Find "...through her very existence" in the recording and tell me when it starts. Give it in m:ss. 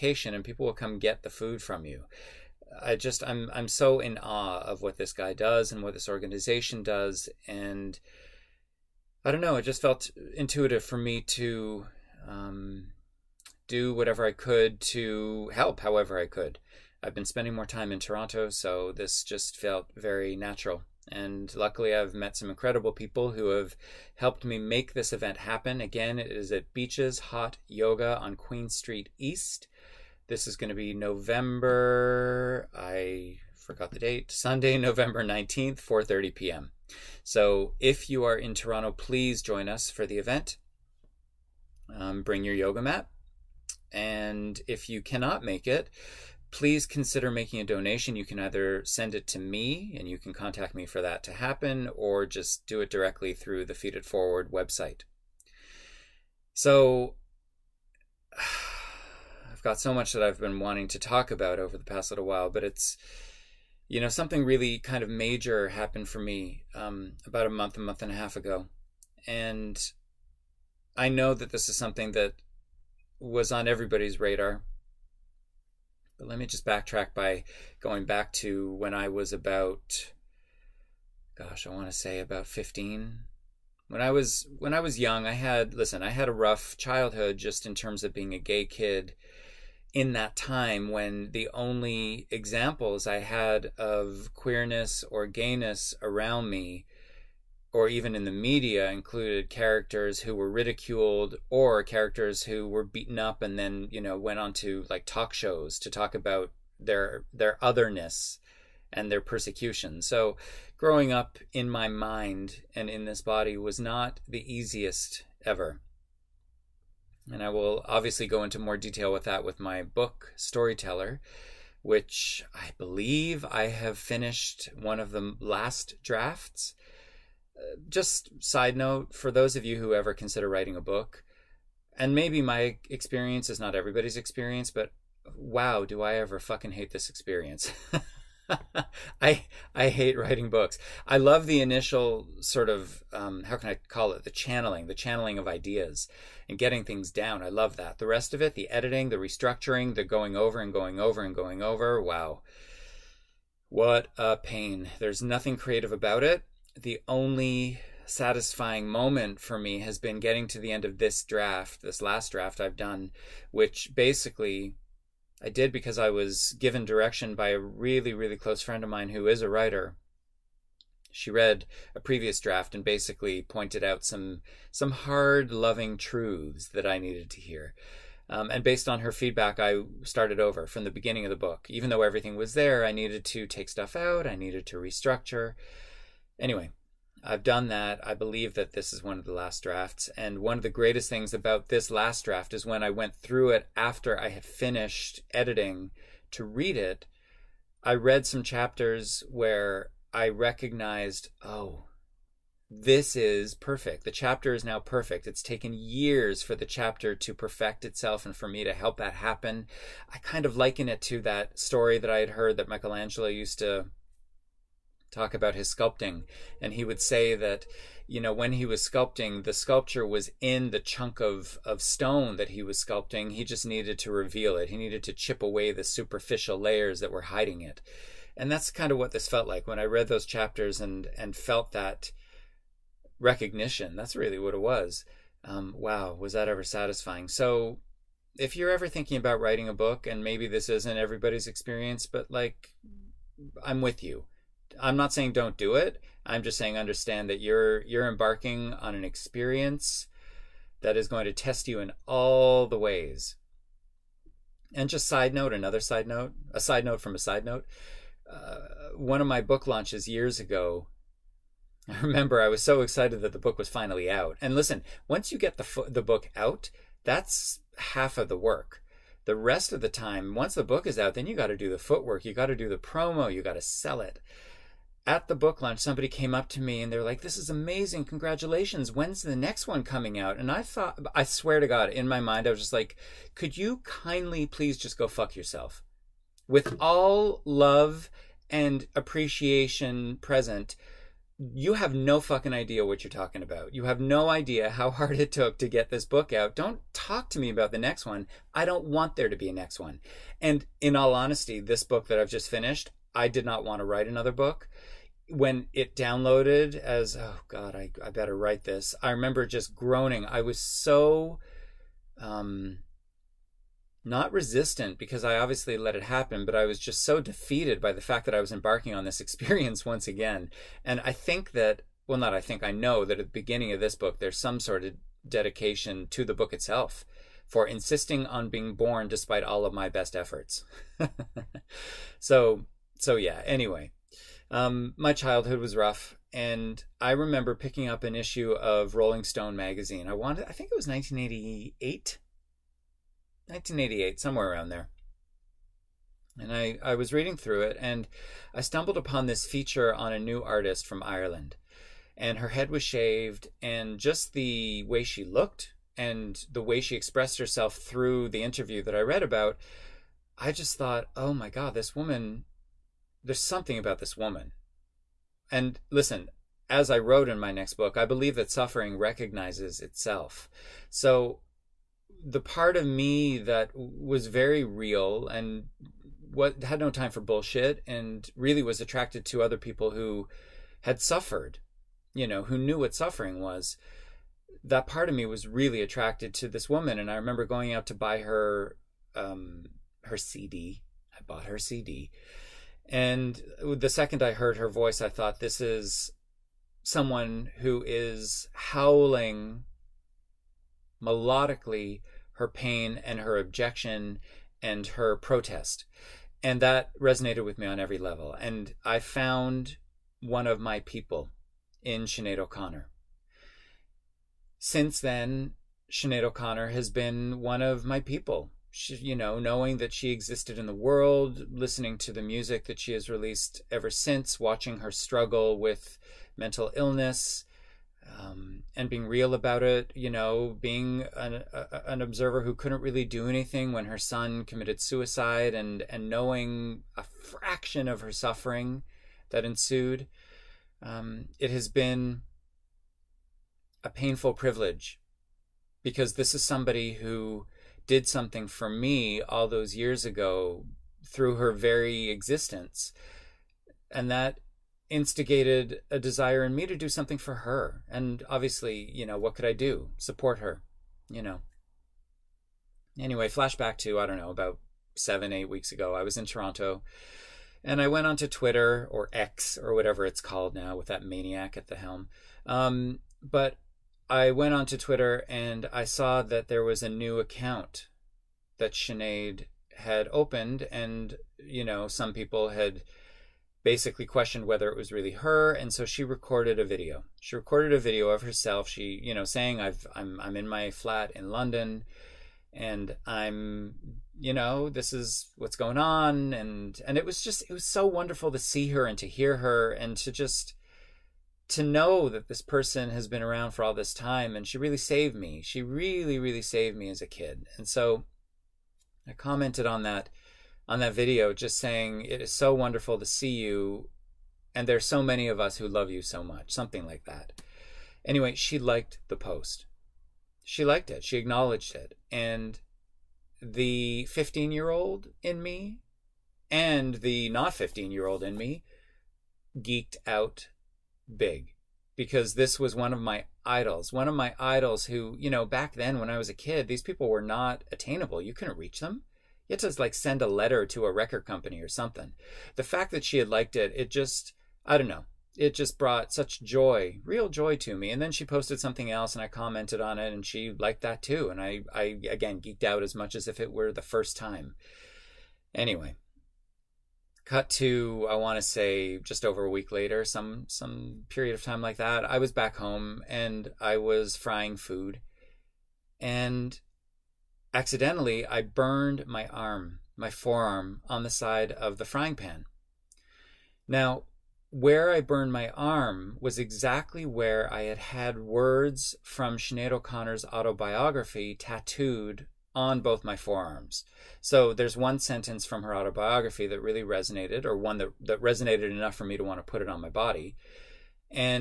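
7:31.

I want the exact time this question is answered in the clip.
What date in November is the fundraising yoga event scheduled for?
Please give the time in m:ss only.
0:34.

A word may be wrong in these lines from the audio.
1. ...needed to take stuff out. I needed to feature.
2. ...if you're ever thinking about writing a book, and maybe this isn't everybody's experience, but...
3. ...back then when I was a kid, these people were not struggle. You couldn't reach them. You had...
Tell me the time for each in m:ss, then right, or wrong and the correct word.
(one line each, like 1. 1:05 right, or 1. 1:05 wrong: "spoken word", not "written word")
1. 3:02 wrong: "restructure", not "feature"
2. 3:58 right
3. 8:55 wrong: "attainable", not "struggle".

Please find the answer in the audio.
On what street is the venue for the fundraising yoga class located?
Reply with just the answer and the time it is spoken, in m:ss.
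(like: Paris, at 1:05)
Queen Street East, at 0:28.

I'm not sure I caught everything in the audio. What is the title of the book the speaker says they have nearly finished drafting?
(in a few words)
Storyteller.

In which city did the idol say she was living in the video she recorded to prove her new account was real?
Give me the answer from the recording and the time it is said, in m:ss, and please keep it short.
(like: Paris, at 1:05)
London, at 8:11.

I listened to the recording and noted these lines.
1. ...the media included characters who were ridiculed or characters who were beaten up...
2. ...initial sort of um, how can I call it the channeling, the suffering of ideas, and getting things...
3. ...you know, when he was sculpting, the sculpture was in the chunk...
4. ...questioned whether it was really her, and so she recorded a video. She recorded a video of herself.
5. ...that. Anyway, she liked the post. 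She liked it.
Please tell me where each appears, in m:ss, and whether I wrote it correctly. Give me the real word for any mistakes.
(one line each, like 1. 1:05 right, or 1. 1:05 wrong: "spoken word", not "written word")
1. 1:38 right
2. 2:21 wrong: "channeling", not "suffering"
3. 3:38 right
4. 8:04 right
5. 8:37 right.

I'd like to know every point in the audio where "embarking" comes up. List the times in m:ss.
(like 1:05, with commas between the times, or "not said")
4:08, 5:18.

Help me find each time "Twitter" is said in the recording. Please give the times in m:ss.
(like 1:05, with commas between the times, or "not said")
7:48, 7:54.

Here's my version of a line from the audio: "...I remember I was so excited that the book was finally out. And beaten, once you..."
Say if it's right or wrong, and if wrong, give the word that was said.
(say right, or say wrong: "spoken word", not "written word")
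wrong: "listen", not "beaten".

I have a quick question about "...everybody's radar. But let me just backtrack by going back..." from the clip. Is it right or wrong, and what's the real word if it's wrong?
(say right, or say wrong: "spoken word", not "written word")
right.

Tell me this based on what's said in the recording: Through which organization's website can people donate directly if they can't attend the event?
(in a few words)
Feed It Forward.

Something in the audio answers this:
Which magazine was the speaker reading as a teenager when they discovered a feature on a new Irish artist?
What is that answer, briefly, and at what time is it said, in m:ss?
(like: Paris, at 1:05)
Rolling Stone, at 5:38.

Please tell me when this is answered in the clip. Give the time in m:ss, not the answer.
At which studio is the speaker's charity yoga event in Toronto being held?
0:26.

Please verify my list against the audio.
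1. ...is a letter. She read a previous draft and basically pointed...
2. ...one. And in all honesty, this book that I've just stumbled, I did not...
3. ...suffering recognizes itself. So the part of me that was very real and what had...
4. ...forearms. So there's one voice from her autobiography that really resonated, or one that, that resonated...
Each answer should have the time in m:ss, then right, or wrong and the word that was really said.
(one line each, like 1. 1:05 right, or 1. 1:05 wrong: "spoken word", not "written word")
1. 2:49 wrong: "writer", not "letter"
2. 4:59 wrong: "finished", not "stumbled"
3. 6:08 right
4. 9:43 wrong: "sentence", not "voice".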